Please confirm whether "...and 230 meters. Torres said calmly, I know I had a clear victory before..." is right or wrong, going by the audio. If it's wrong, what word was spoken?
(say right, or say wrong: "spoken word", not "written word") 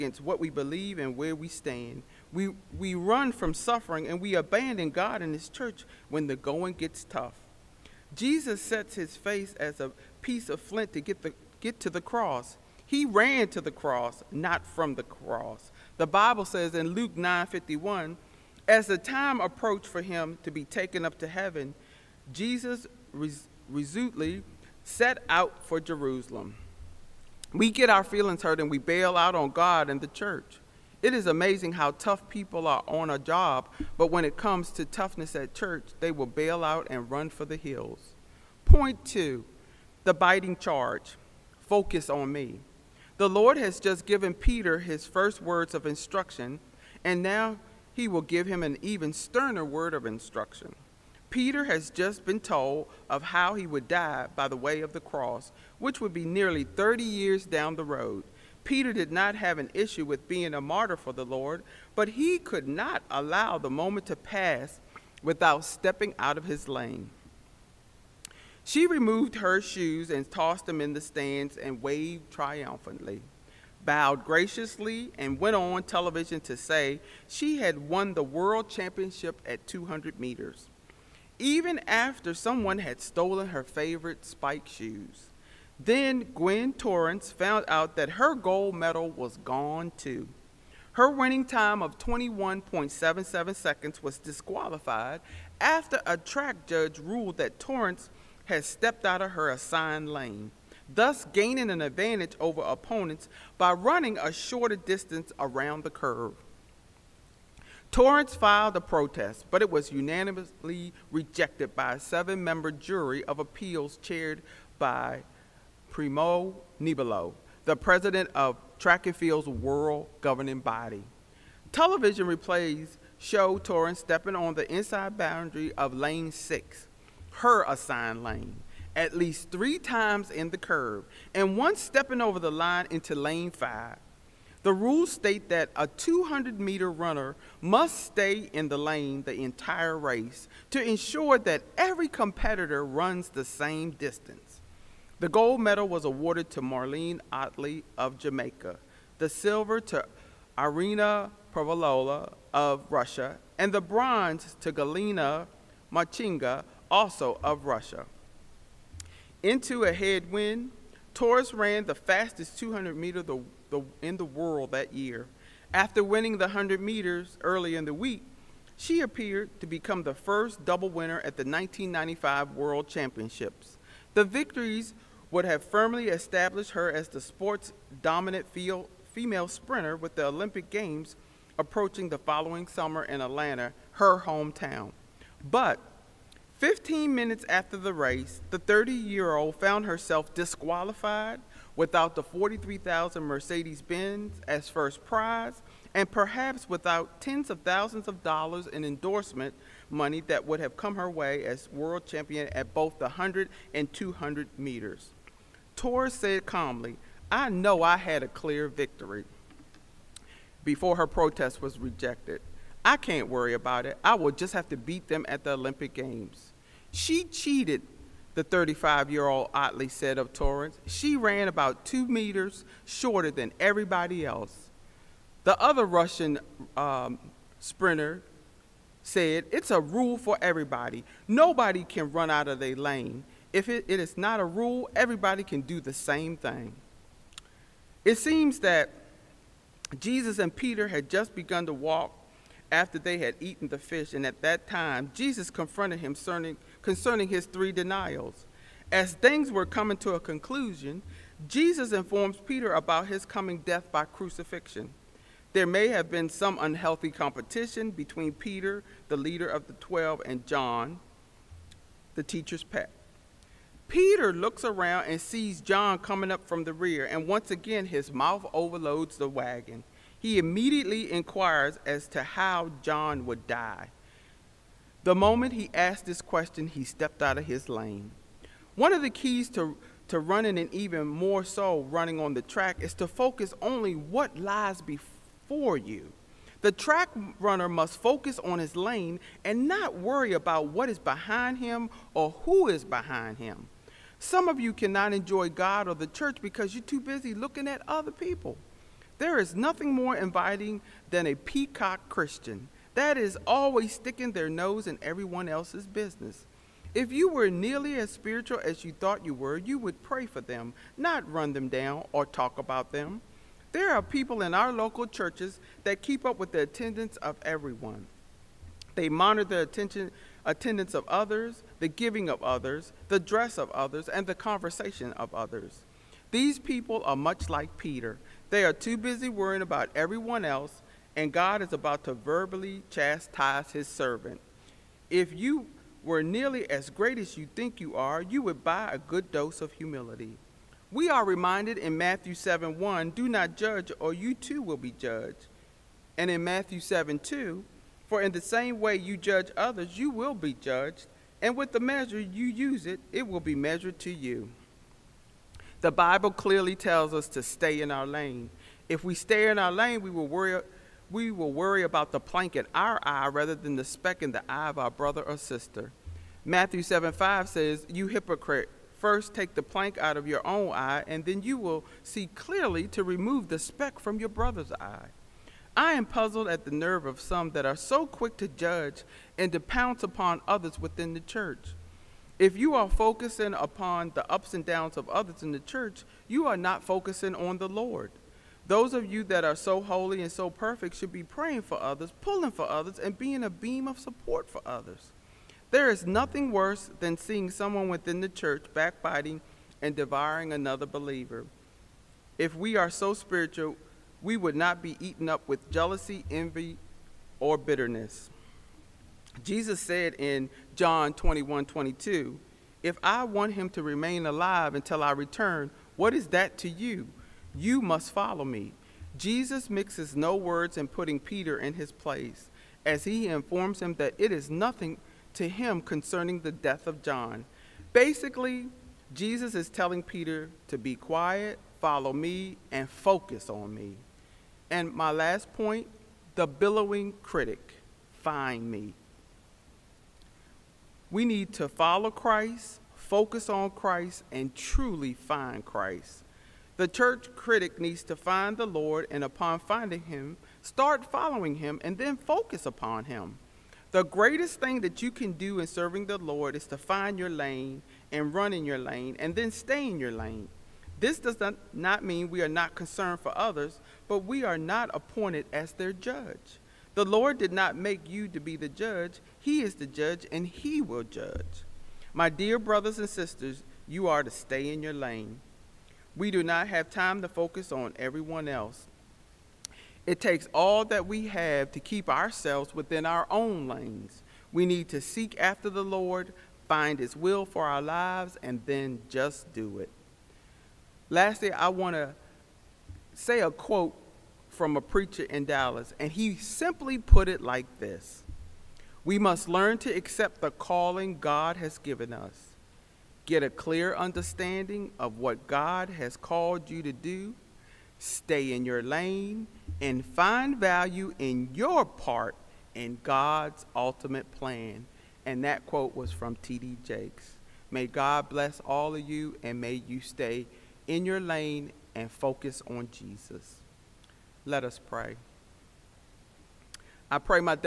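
wrong: "200", not "230".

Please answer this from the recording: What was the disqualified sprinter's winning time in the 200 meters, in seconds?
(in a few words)
21.77.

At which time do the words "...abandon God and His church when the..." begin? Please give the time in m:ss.
0:04.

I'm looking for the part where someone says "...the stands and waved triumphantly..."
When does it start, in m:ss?
1:10.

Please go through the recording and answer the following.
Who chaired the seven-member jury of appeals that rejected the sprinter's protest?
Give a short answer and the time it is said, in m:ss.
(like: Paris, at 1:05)
Primo Nebiolo, at 1:55.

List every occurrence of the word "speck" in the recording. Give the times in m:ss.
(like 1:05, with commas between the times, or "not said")
6:03, 6:13.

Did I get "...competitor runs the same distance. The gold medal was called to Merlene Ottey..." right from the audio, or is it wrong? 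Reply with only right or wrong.
wrong.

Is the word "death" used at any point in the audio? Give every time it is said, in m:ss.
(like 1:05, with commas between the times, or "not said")
4:13, 7:06.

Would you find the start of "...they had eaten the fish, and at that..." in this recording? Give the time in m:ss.
4:02.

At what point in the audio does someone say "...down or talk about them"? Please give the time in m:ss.
5:11.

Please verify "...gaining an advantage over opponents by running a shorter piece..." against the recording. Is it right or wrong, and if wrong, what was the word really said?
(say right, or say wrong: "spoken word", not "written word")
wrong: "distance", not "piece".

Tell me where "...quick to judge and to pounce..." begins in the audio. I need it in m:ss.
6:18.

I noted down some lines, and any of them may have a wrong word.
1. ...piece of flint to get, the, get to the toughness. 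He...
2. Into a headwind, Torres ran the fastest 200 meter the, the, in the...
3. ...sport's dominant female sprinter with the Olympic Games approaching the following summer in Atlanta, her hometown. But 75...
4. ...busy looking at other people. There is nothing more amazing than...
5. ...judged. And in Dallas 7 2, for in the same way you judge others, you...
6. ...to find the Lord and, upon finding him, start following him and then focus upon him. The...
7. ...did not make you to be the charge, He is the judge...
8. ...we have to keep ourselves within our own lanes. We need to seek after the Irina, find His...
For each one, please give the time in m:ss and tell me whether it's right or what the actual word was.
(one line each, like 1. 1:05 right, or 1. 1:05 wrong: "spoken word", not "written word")
1. 0:10 wrong: "cross", not "toughness"
2. 2:39 right
3. 2:57 wrong: "15", not "75"
4. 4:56 wrong: "inviting", not "amazing"
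5. 5:44 wrong: "Matthew", not "Dallas"
6. 7:28 right
7. 7:47 wrong: "judge", not "charge"
8. 8:01 wrong: "Lord", not "Irina".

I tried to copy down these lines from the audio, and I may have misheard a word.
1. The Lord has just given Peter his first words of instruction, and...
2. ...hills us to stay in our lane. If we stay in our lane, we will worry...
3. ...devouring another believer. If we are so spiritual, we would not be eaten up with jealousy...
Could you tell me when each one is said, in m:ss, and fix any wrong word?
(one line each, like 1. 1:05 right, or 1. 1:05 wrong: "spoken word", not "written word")
1. 0:43 right
2. 5:56 wrong: "tells", not "hills"
3. 6:39 right.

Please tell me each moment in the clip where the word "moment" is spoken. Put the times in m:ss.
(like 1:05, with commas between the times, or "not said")
1:03, 4:35.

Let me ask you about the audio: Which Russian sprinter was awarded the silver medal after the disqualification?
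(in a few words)
Irina Privalova.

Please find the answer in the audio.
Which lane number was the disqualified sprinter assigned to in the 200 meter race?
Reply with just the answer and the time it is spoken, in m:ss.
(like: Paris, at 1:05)
Lane 6, at 2:05.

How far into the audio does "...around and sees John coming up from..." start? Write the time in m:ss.
4:24.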